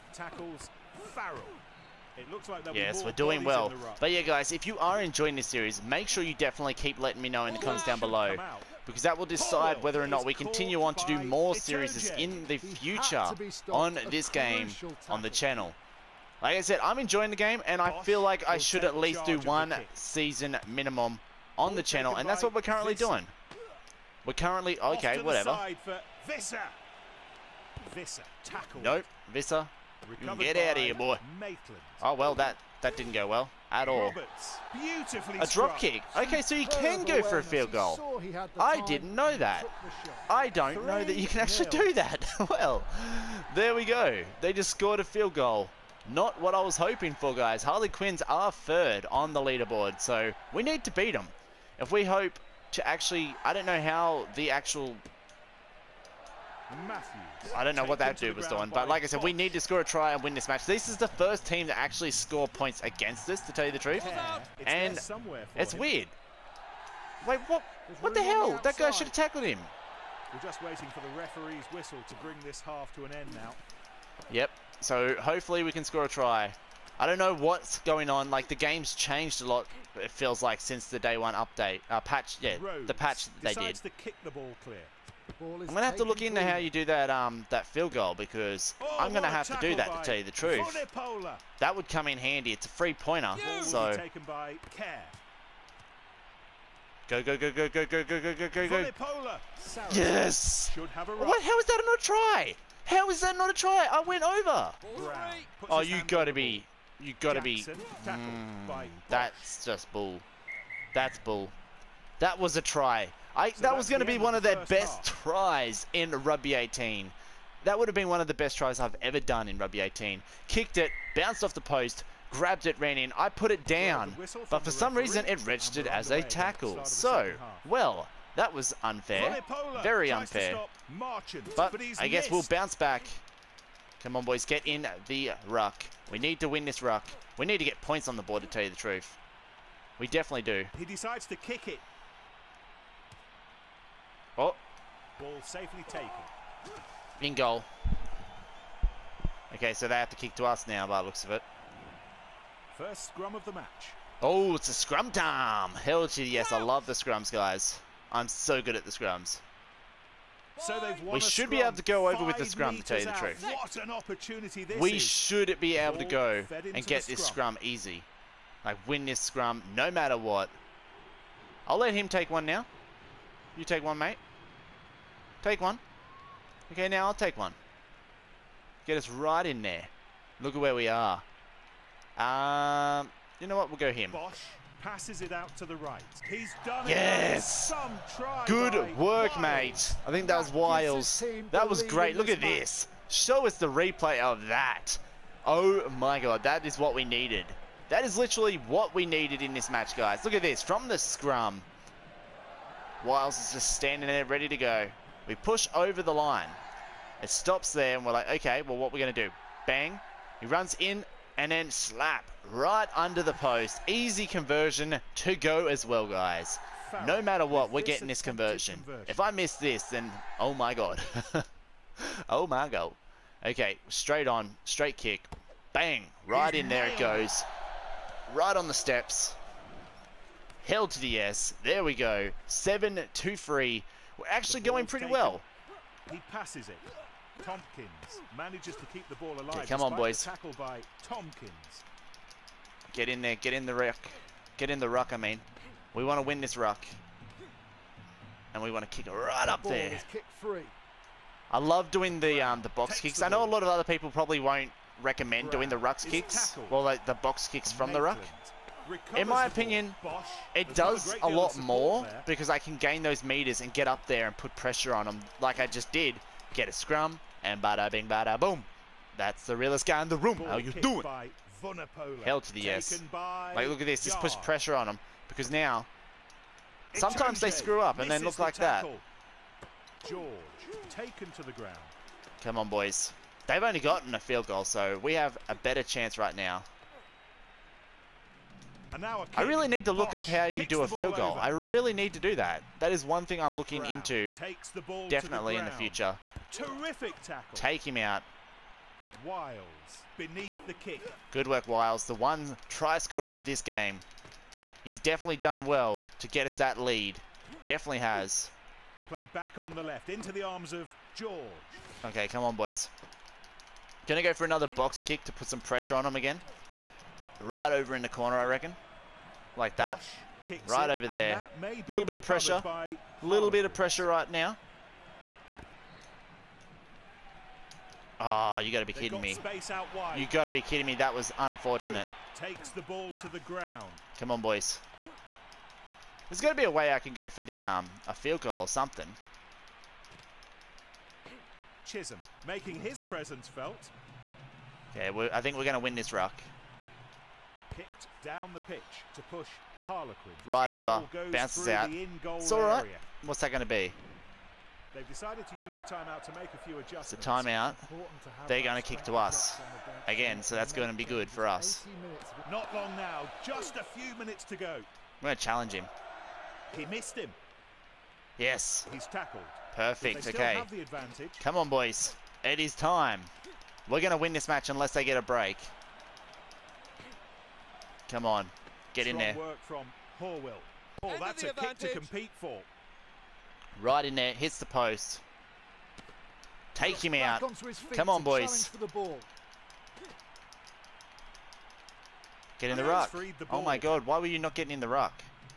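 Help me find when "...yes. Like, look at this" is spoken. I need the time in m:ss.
4:32.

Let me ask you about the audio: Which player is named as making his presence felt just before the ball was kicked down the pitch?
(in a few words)
Chisholm.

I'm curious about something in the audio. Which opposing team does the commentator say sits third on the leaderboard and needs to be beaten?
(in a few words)
Harlequins.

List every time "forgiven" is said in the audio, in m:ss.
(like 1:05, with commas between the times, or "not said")
not said.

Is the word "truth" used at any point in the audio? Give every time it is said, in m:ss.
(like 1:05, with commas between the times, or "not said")
1:03, 1:30, 2:18, 2:43.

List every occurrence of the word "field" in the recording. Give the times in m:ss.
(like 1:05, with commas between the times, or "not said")
0:37, 0:45, 1:27, 4:44, 4:50, 5:38.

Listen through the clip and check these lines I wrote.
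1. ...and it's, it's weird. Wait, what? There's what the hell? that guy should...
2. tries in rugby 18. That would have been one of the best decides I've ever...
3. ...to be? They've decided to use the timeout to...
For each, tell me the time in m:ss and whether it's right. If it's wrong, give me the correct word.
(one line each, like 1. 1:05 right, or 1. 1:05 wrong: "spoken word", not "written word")
1. 1:04 right
2. 1:55 wrong: "tries", not "decides"
3. 5:53 right.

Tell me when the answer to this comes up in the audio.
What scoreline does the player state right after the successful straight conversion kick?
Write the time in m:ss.
3:52.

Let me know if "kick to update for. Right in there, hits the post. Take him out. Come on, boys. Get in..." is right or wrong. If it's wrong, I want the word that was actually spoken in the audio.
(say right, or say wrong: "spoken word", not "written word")
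wrong: "compete", not "update".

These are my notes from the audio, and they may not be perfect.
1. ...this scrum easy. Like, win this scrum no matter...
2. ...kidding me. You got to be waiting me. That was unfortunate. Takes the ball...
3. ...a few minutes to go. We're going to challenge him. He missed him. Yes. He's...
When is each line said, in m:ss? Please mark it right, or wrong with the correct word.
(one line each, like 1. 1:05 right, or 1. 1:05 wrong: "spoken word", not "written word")
1. 2:47 right
2. 5:28 wrong: "kidding", not "waiting"
3. 6:03 right.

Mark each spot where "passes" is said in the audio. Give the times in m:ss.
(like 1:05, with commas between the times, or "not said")
3:04, 3:56.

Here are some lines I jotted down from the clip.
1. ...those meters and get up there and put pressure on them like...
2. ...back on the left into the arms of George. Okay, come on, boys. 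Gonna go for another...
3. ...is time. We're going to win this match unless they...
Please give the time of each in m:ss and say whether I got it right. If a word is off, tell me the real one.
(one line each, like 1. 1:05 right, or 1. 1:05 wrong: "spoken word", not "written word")
1. 4:23 right
2. 5:09 right
3. 6:12 right.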